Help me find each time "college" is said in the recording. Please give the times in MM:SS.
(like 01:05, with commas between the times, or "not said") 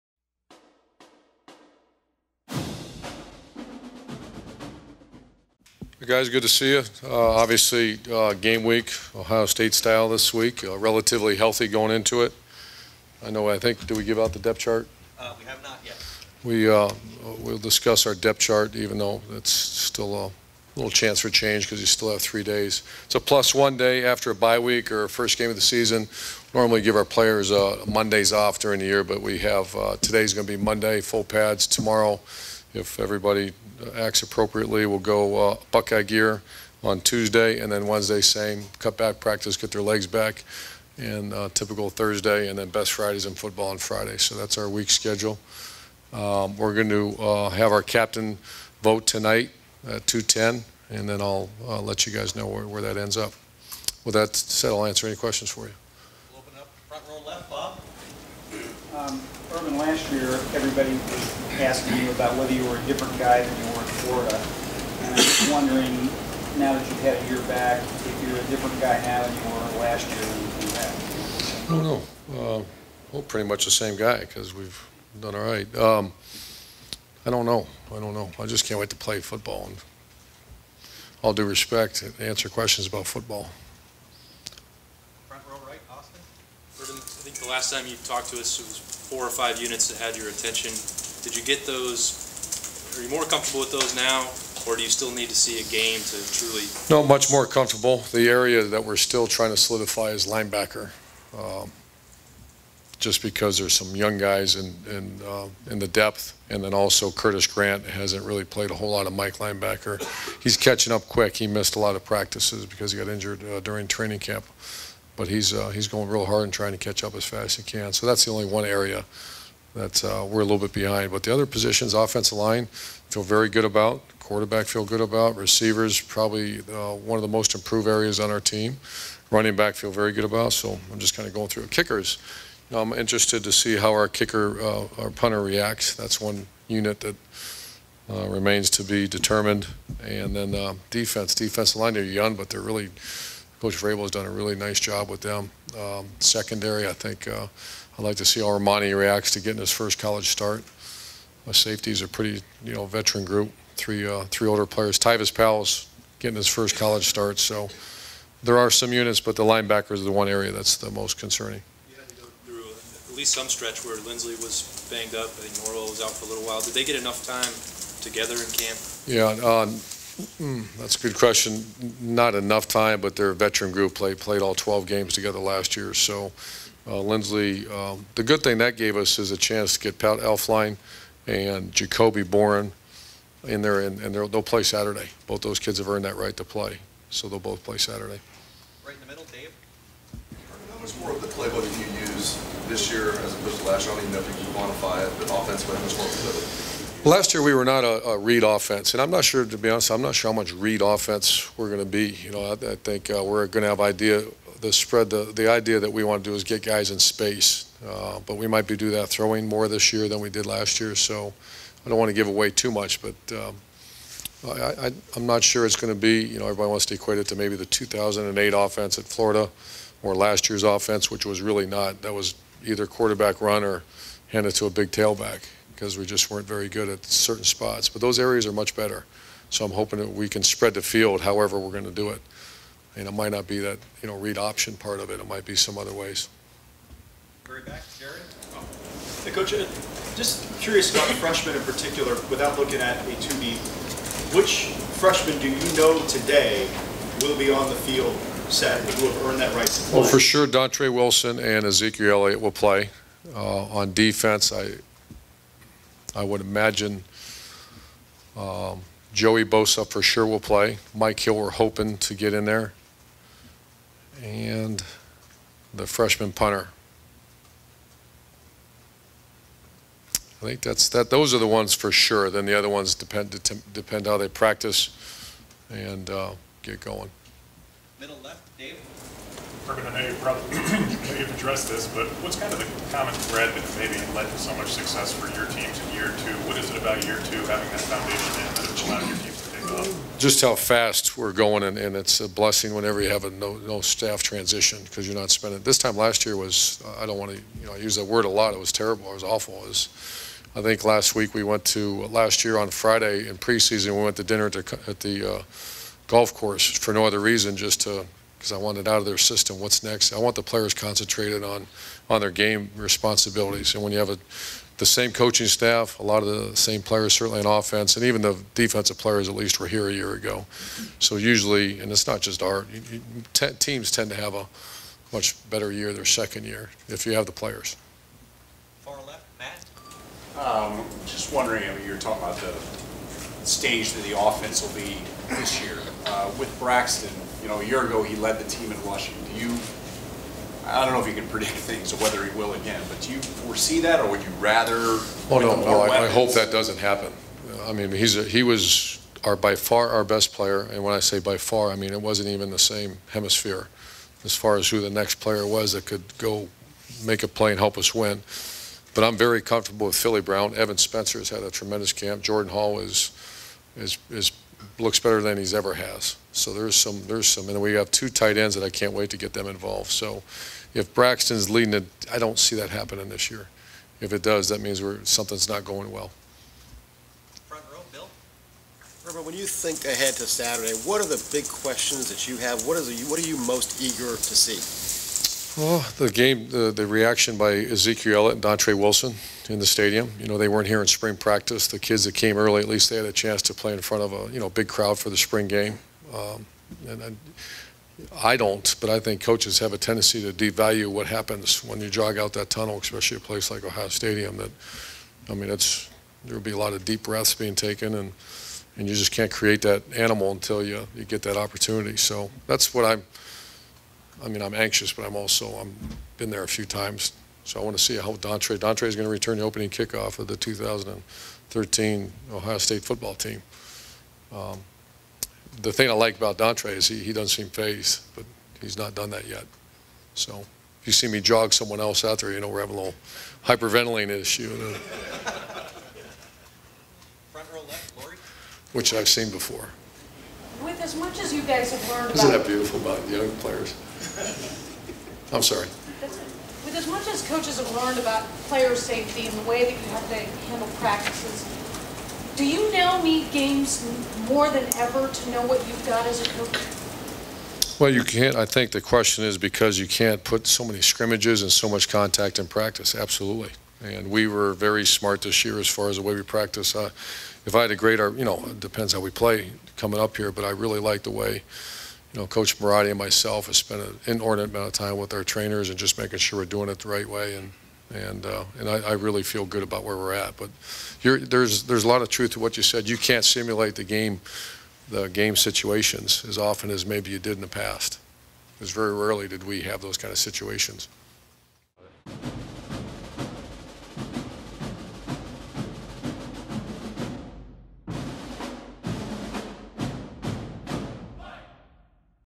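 02:29, 02:36.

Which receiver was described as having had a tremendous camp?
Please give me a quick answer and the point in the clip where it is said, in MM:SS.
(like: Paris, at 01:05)
Evan Spencer, at 06:00.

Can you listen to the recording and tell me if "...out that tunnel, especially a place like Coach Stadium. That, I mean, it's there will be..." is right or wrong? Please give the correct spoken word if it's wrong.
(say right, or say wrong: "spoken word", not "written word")
wrong: "Ohio", not "Coach".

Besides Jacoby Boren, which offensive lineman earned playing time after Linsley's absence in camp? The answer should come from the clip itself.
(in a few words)
Pat Elflein.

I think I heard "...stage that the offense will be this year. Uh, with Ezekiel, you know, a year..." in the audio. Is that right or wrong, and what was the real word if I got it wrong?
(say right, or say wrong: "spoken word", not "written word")
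wrong: "Braxton", not "Ezekiel".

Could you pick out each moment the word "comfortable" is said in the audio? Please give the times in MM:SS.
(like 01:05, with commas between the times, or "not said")
01:33, 01:37, 05:59.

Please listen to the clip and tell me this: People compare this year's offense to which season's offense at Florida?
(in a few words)
2008.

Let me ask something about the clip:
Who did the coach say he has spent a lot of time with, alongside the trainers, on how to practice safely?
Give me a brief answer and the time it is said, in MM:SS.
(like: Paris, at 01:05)
Coach Marotti, at 07:52.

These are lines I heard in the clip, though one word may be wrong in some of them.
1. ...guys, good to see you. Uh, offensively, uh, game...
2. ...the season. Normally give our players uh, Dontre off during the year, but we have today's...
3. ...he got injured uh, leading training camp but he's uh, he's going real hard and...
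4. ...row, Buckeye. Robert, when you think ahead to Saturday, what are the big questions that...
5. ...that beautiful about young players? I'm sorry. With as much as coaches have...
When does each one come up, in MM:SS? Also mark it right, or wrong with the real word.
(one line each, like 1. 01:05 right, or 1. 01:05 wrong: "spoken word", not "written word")
1. 00:06 wrong: "obviously", not "offensively"
2. 00:25 wrong: "Mondays", not "Dontre"
3. 01:52 wrong: "during", not "leading"
4. 06:17 wrong: "Bill", not "Buckeye"
5. 07:22 right.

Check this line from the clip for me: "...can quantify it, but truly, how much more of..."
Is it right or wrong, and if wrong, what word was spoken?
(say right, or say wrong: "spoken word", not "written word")
wrong: "offensively", not "truly".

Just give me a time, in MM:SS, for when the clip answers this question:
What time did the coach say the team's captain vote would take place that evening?
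00:50.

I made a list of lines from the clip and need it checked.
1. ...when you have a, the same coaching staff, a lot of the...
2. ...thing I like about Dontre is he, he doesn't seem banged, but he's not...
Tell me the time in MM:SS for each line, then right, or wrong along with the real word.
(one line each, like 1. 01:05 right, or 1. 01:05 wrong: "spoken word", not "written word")
1. 05:13 right
2. 07:05 wrong: "phased", not "banged".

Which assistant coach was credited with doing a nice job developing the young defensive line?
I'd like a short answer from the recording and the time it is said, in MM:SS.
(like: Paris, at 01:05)
Coach Vrabel, at 02:23.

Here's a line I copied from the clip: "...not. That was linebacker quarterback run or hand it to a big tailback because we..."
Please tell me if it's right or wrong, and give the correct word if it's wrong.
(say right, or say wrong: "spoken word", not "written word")
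wrong: "either", not "linebacker".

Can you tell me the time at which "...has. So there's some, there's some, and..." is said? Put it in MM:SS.
06:05.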